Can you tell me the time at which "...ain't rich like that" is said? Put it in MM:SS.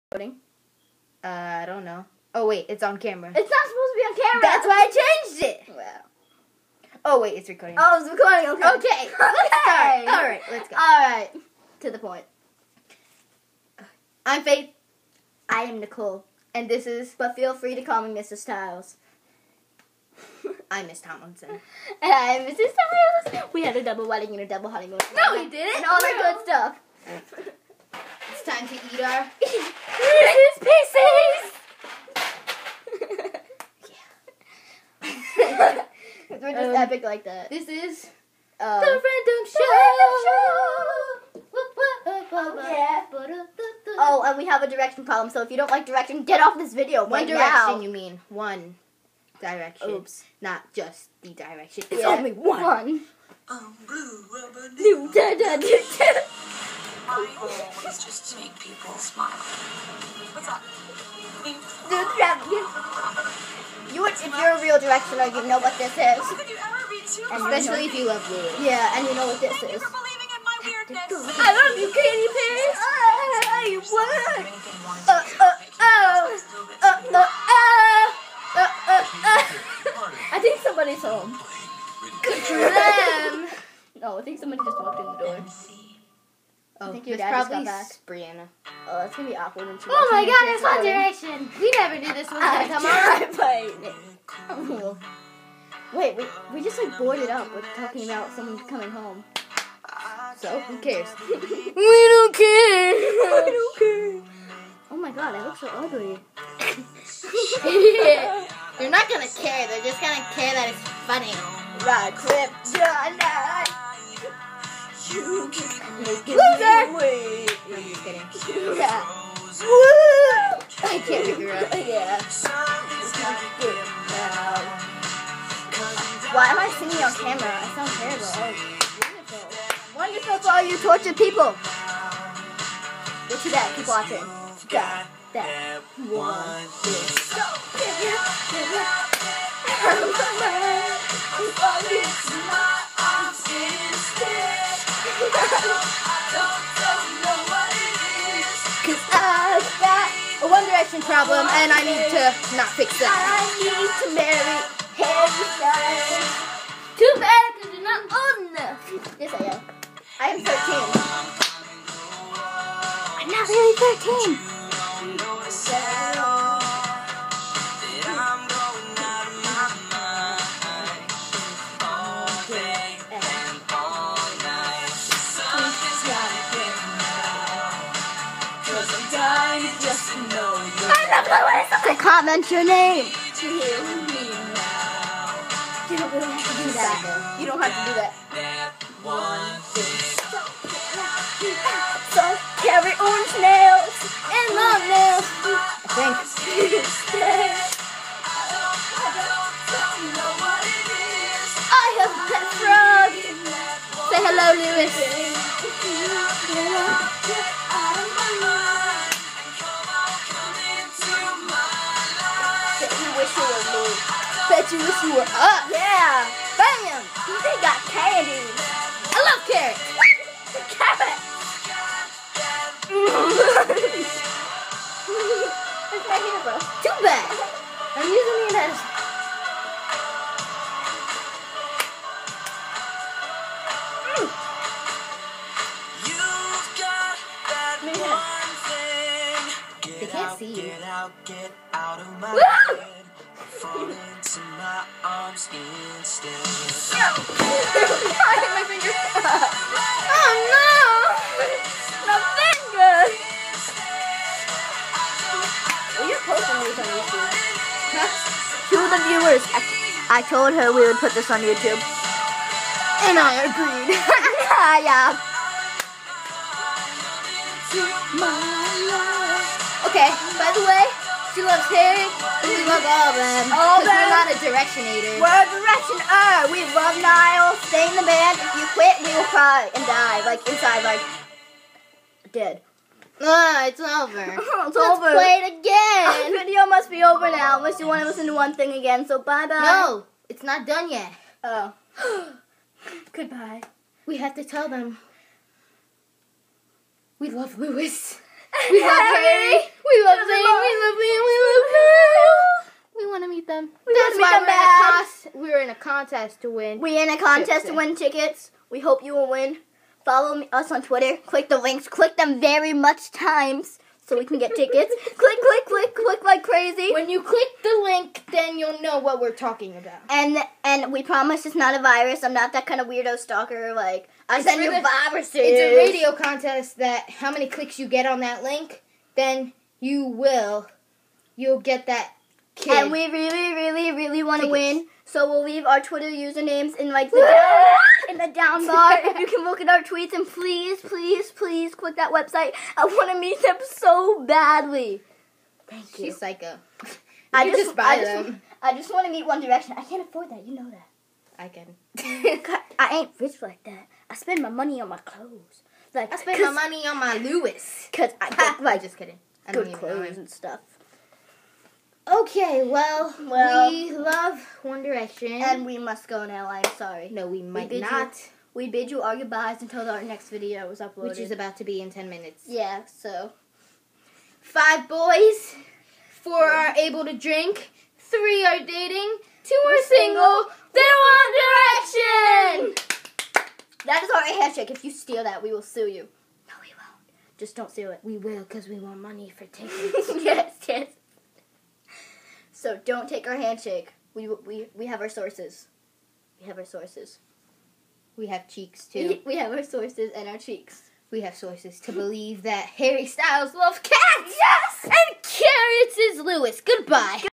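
05:52.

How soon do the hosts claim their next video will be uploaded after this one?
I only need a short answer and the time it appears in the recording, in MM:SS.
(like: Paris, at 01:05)
10 minutes, at 06:11.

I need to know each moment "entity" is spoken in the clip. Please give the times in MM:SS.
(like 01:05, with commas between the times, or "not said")
not said.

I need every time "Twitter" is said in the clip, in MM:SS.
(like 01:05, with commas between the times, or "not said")
05:10, 05:35.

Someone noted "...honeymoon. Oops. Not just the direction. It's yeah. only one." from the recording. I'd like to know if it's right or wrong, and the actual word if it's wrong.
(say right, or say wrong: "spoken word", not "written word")
wrong: "direction", not "honeymoon".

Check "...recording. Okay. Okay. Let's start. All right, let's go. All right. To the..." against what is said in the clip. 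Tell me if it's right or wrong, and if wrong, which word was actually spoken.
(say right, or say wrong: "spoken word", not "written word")
right.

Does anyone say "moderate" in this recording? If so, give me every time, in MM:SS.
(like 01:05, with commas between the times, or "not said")
not said.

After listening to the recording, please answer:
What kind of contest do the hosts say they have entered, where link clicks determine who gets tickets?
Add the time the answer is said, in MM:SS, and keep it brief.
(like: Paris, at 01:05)
A radio contest, at 05:25.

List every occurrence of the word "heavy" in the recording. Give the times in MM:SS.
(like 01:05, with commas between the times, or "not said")
not said.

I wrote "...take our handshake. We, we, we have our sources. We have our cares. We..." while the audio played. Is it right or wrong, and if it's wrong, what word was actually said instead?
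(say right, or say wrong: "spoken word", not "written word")
wrong: "sources", not "cares".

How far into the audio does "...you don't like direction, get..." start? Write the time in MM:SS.
00:45.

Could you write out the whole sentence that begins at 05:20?
And and we promise it's not a virus.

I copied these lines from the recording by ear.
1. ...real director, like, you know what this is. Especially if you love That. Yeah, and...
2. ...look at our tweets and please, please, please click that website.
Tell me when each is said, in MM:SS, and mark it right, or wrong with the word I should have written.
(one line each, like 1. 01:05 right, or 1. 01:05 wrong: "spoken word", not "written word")
1. 01:04 wrong: "Lulu", not "That"
2. 05:39 right.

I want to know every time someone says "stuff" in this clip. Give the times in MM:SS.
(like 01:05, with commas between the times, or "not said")
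00:26, 06:00.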